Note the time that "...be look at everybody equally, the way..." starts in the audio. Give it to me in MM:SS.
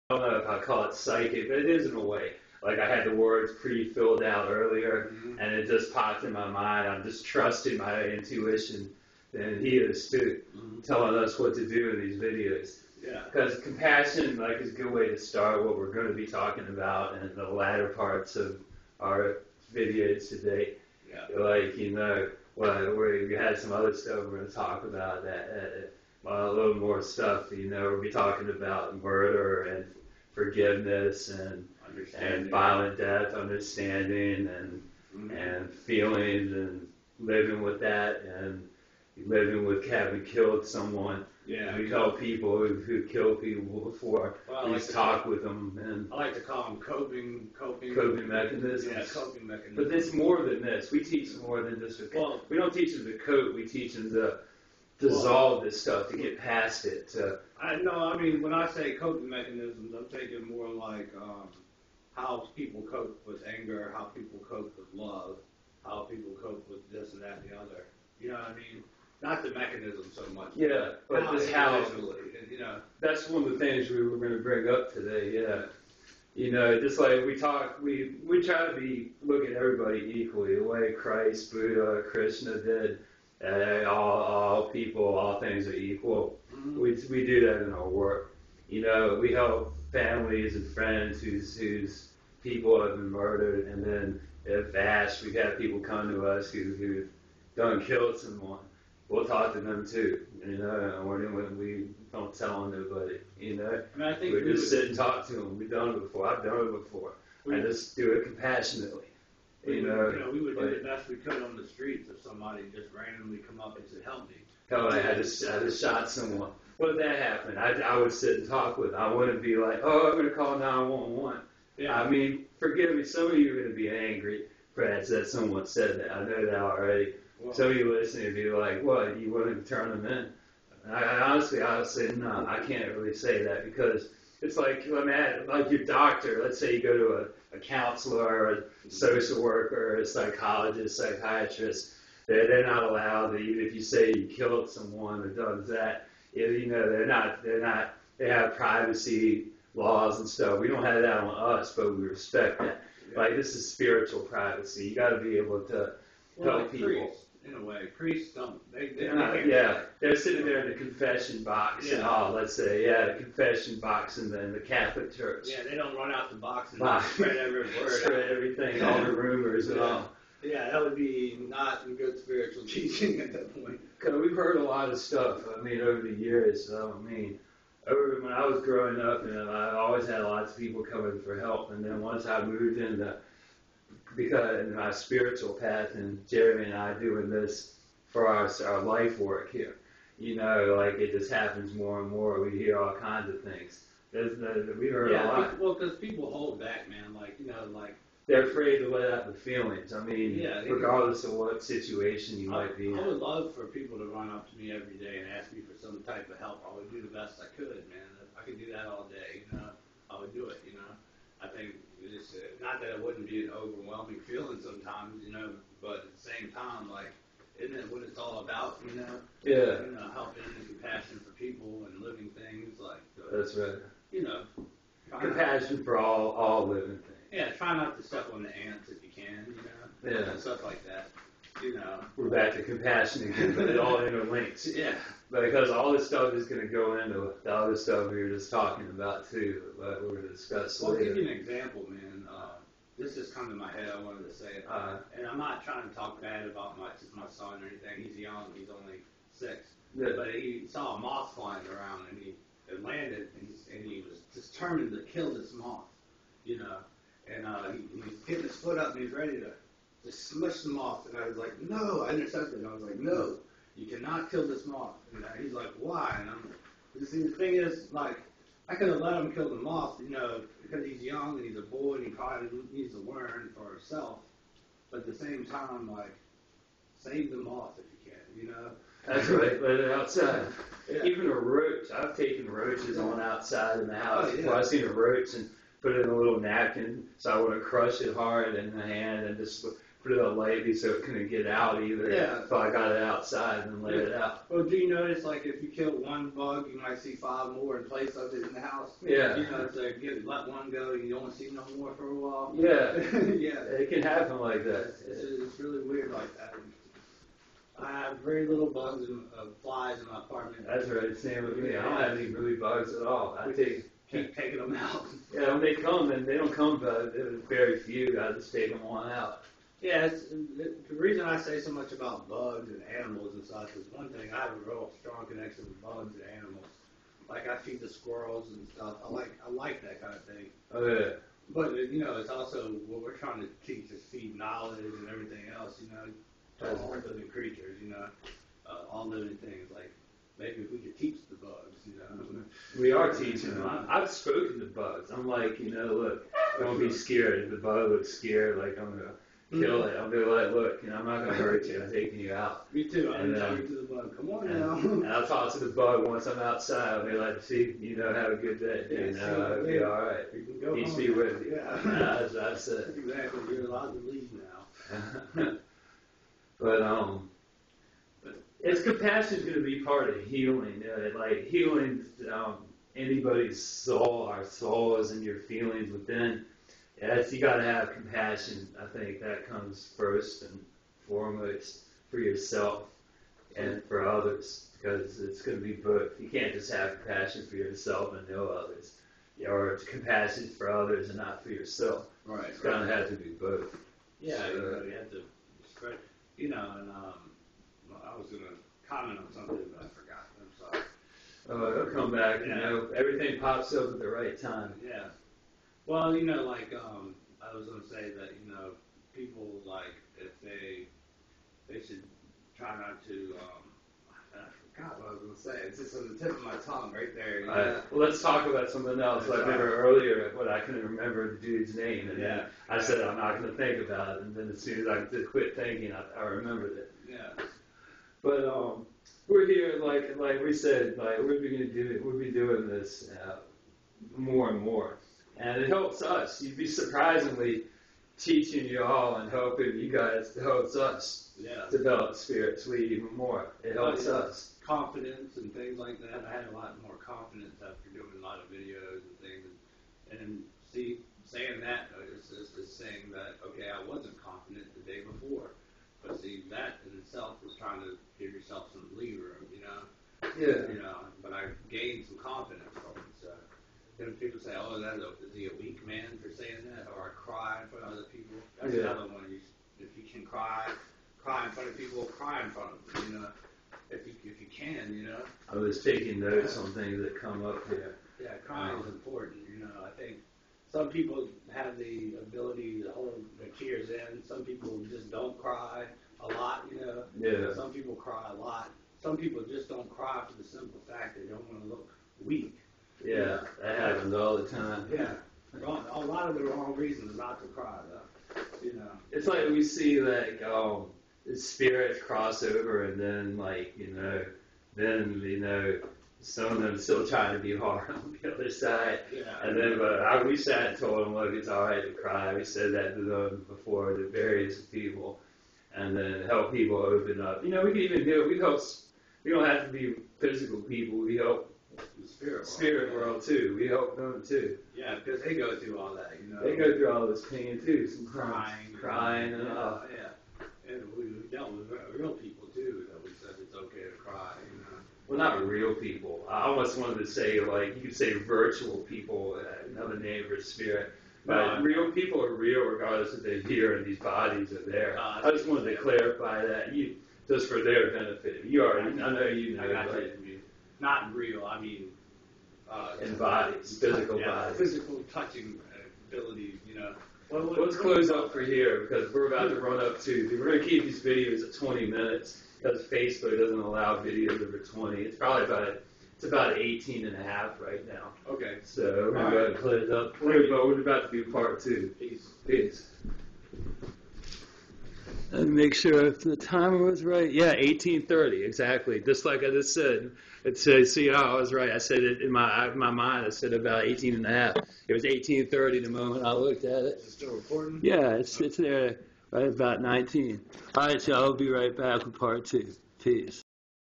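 01:18.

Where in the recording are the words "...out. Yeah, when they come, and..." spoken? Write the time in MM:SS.
05:14.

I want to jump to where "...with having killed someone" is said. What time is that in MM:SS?
00:39.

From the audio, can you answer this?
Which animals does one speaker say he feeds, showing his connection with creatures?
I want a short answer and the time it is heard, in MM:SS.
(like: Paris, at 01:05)
squirrels, at 05:27.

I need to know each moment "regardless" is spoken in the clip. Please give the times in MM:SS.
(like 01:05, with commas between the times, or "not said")
03:20, 09:02.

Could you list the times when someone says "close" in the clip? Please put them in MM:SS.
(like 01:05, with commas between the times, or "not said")
09:17, 09:29.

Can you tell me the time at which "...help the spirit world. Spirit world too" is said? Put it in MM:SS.
08:41.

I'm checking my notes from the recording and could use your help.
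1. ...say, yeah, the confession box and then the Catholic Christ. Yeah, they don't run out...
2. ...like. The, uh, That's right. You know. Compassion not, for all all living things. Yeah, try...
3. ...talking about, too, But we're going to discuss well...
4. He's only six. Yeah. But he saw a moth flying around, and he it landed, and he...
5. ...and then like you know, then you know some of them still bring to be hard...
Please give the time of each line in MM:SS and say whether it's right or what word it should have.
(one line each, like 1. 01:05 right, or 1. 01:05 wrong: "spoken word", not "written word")
1. 02:42 wrong: "Church", not "Christ"
2. 03:42 right
3. 03:58 right
4. 04:08 right
5. 08:22 wrong: "trying", not "bring".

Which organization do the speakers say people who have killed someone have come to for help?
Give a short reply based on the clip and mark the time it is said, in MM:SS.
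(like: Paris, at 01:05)
VASH, at 01:34.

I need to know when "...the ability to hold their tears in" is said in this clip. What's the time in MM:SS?
08:01.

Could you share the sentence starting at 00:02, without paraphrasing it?
Like I had the words pre-filled out earlier, mm-hmm.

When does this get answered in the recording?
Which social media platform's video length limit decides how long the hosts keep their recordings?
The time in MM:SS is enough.
09:22.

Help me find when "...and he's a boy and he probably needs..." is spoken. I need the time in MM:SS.
04:31.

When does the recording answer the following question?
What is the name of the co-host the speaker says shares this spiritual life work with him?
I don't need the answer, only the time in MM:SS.
03:06.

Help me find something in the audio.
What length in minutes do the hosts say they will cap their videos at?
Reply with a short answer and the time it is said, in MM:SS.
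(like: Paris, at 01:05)
20, at 09:21.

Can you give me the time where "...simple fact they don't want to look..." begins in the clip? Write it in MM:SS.
08:10.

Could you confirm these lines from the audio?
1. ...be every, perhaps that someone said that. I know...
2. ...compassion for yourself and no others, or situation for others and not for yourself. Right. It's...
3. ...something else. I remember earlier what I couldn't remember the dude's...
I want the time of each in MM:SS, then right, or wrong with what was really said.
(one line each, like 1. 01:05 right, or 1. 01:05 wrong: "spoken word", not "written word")
1. 02:03 wrong: "angry", not "every"
2. 06:27 wrong: "compassion", not "situation"
3. 06:58 right.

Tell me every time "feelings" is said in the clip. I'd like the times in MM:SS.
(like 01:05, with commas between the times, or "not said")
00:35, 03:19, 03:34, 06:15.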